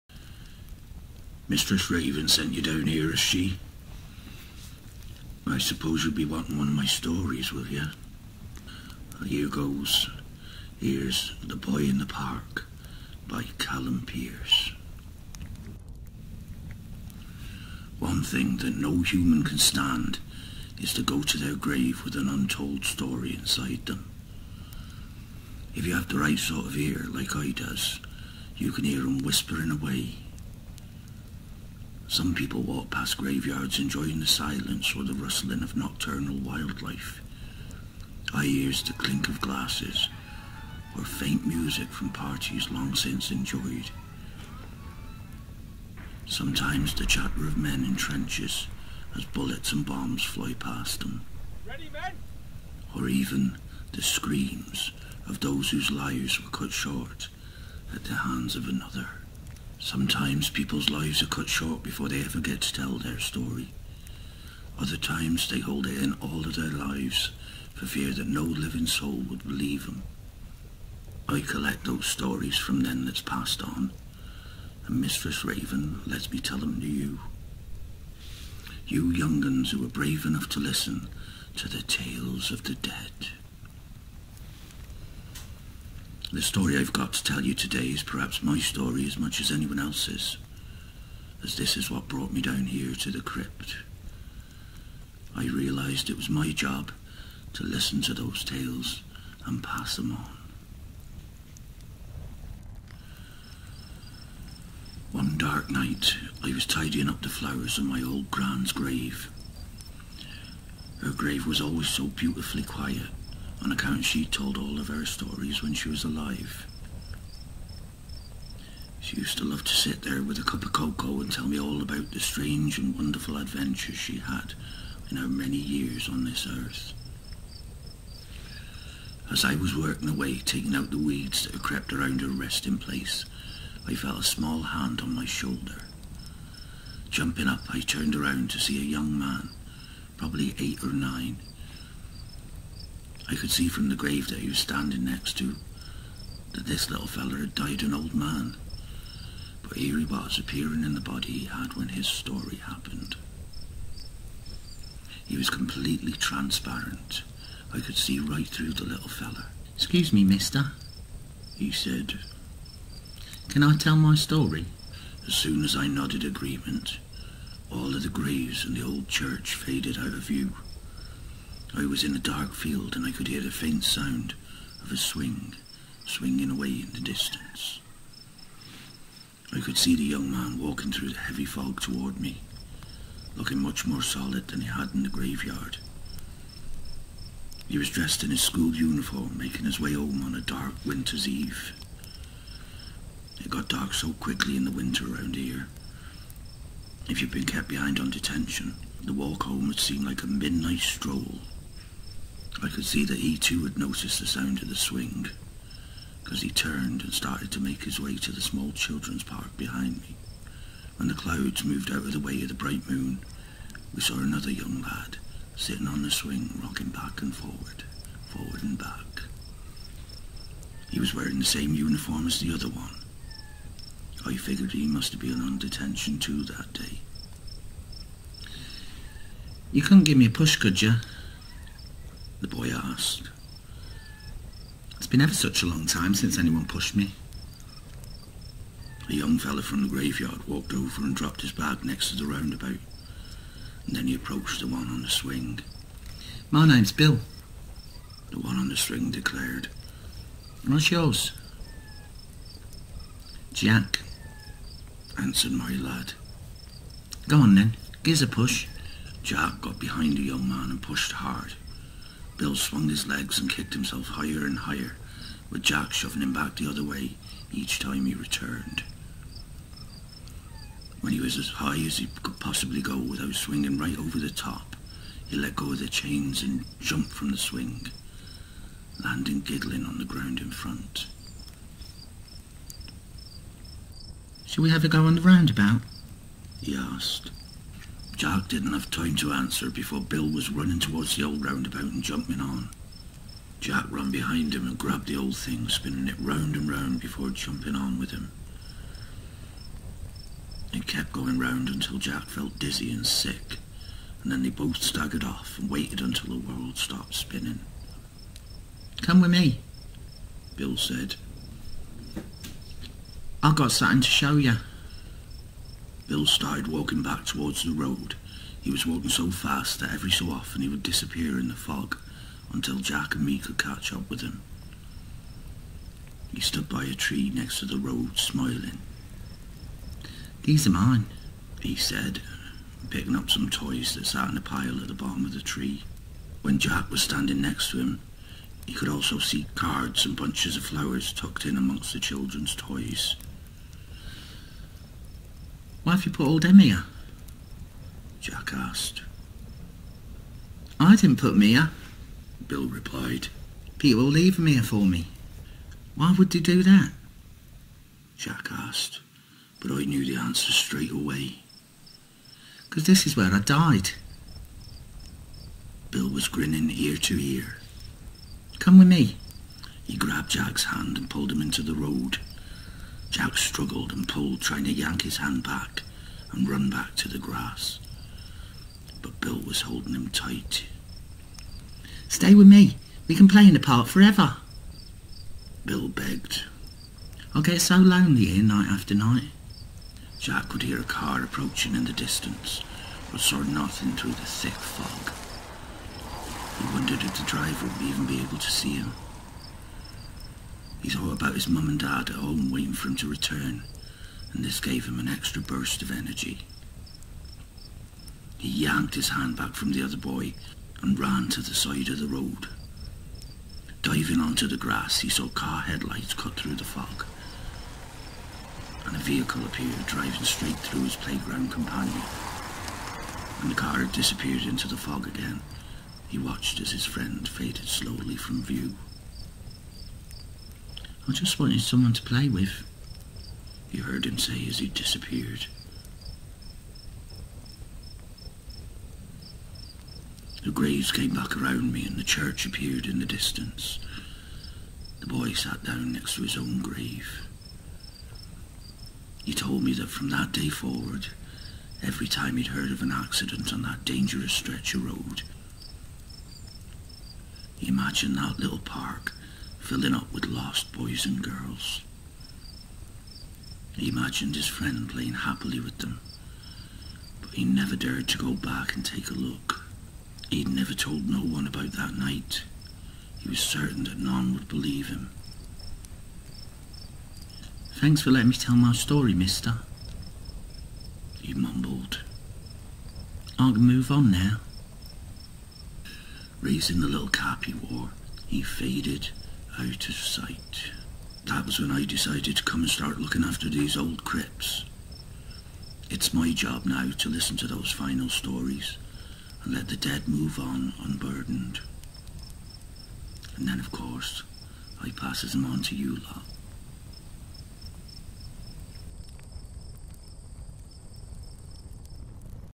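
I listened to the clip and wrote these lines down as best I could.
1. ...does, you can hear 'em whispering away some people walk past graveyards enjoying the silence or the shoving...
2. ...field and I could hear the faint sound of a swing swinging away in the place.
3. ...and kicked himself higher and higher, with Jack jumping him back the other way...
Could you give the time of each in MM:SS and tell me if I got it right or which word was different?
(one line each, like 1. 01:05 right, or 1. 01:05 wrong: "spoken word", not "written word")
1. 00:27 wrong: "rustling", not "shoving"
2. 02:52 wrong: "distance", not "place"
3. 04:23 wrong: "shoving", not "jumping".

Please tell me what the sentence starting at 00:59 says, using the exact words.
Sometimes people's lives are cut short before they ever get to tell their story.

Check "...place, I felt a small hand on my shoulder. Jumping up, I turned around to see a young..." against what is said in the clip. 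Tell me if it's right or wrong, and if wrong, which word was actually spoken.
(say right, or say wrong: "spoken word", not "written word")
right.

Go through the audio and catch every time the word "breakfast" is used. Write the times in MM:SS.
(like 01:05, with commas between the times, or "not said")
not said.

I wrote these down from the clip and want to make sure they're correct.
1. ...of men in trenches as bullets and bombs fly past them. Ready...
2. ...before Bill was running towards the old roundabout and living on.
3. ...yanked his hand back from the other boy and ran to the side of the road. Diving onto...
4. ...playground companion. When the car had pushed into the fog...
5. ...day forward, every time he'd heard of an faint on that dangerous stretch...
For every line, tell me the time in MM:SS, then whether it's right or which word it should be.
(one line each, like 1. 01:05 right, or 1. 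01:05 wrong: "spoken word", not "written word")
1. 00:47 right
2. 04:49 wrong: "jumping", not "living"
3. 06:48 right
4. 07:00 wrong: "disappeared", not "pushed"
5. 07:30 wrong: "accident", not "faint".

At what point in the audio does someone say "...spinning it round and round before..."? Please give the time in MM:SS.
04:55.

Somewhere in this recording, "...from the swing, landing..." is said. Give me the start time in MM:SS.
04:37.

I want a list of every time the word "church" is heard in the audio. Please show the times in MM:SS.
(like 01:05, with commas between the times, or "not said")
02:49, 07:22.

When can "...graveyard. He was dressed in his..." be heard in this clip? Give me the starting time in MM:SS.
03:05.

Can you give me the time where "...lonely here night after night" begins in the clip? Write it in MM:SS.
06:27.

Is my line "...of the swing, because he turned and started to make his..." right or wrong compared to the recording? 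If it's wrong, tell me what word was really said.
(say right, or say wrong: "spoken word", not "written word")
right.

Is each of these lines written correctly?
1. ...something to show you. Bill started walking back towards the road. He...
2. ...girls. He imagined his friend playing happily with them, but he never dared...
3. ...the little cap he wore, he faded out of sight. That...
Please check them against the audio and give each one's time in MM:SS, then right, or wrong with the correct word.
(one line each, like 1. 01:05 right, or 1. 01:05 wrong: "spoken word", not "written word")
1. 05:13 right
2. 07:41 right
3. 08:06 right.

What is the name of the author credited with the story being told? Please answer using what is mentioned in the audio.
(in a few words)
Callum Pearce.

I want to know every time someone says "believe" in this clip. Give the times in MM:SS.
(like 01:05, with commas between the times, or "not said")
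01:09, 07:54.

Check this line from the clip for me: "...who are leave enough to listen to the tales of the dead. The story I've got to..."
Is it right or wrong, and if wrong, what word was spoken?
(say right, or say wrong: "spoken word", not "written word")
wrong: "brave", not "leave".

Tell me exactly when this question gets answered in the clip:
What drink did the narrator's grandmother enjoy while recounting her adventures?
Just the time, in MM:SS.
02:00.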